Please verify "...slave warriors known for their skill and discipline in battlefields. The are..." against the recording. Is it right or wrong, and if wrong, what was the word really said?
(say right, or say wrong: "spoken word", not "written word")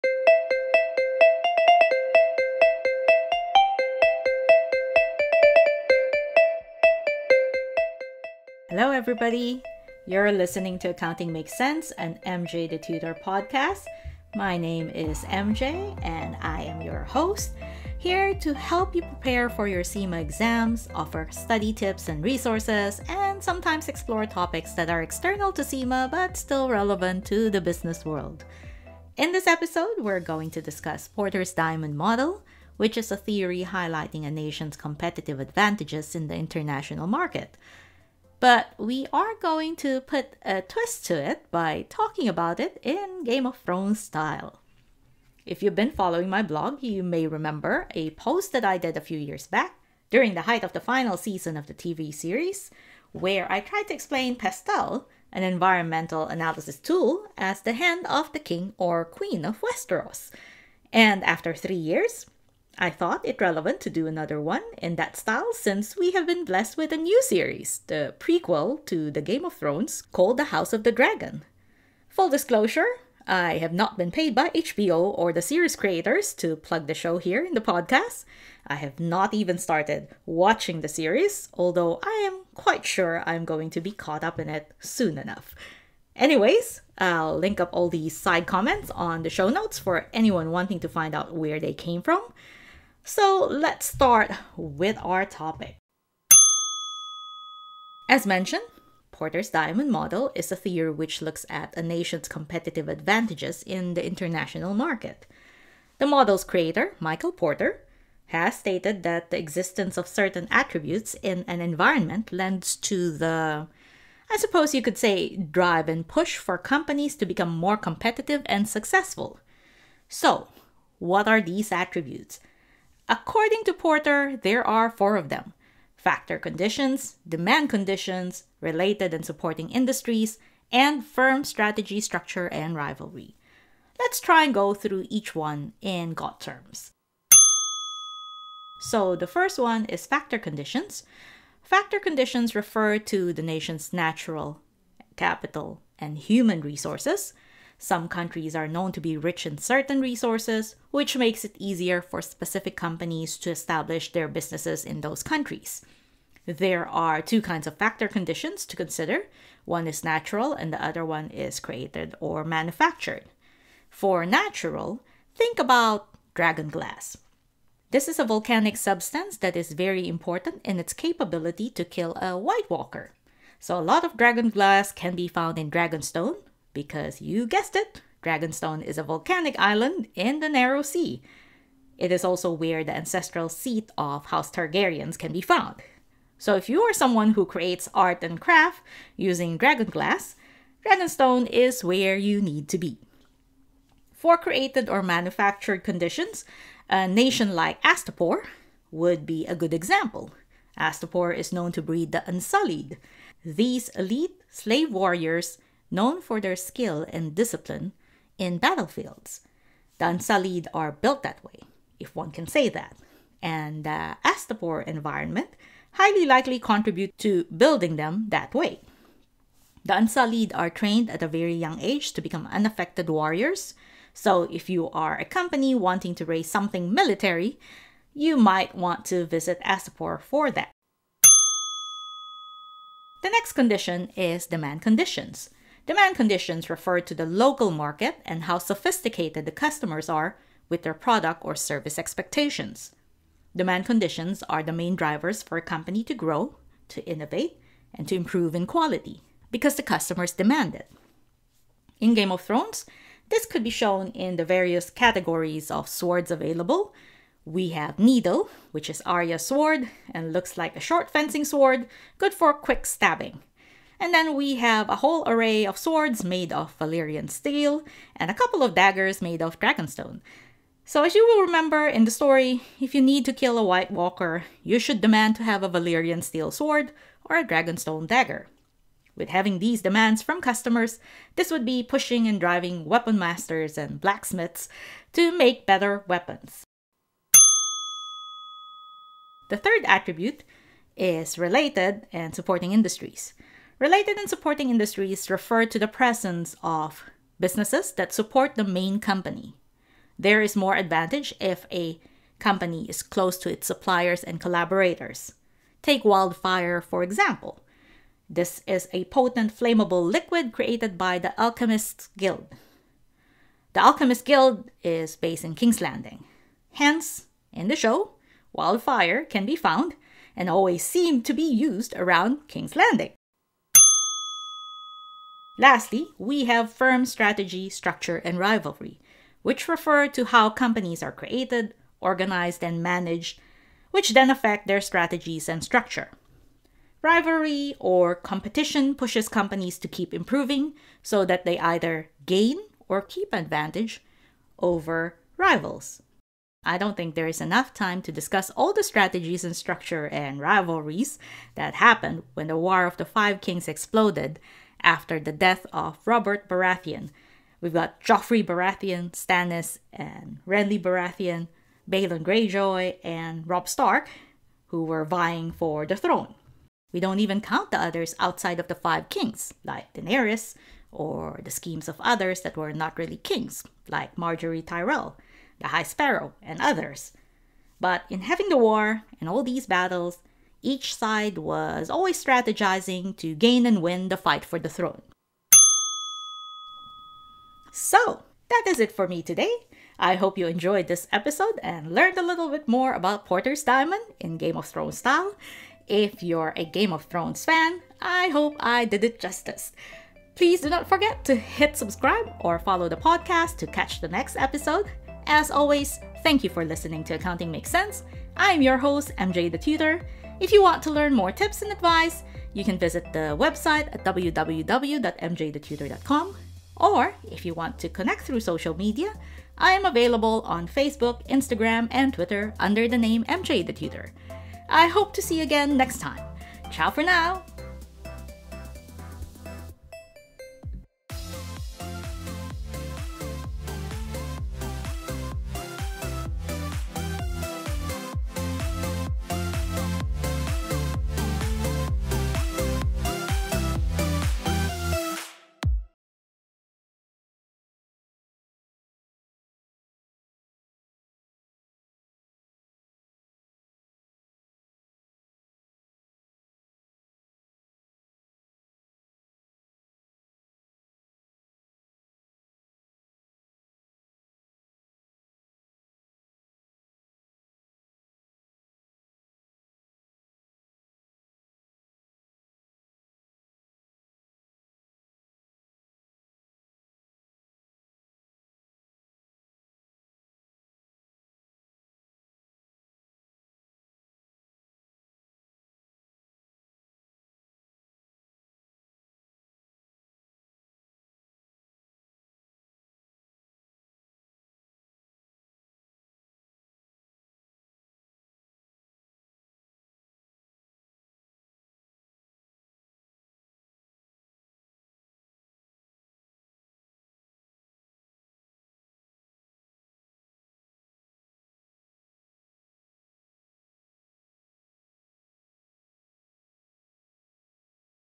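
right.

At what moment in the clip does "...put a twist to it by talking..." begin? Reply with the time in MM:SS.
00:40.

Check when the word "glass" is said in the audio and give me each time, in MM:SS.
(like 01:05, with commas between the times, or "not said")
02:46, 02:54, 03:09.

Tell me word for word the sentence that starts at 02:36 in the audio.
There are two kinds of factor conditions to consider one is natural, and the other one is created or manufactured.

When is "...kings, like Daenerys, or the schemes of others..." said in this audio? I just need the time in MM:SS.
06:09.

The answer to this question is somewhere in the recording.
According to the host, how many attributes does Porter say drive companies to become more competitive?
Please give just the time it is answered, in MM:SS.
02:04.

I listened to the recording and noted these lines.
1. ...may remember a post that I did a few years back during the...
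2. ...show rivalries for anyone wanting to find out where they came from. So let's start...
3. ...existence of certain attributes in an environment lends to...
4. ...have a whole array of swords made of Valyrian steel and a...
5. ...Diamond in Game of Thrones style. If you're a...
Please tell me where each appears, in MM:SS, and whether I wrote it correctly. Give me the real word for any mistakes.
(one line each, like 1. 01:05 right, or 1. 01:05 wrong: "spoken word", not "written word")
1. 00:47 right
2. 01:29 wrong: "notes", not "rivalries"
3. 01:49 right
4. 04:24 right
5. 06:33 right.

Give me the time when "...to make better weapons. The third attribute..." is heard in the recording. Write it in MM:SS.
04:45.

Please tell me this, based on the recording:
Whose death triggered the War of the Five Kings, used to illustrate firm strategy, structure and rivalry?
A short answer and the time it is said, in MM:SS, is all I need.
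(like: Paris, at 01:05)
Robert Baratheon, at 05:56.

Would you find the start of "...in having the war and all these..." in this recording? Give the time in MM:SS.
06:18.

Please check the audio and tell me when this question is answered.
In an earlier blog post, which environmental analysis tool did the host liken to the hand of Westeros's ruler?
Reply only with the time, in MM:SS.
00:54.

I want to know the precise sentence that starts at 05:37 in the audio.
Rivalry or competition pushes companies to keep improving so that they either gain or keep advantage over rivals.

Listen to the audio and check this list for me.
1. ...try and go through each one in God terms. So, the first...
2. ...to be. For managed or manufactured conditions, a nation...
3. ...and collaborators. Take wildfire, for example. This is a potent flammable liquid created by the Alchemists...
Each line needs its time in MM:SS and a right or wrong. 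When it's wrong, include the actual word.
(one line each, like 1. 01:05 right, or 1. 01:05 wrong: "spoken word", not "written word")
1. 02:14 right
2. 03:12 wrong: "created", not "managed"
3. 05:04 right.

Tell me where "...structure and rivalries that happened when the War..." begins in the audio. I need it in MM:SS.
05:49.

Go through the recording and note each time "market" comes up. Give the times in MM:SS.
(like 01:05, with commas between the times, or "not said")
00:37, 01:44, 03:57.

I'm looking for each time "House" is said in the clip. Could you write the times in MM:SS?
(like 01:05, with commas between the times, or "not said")
01:10, 03:04.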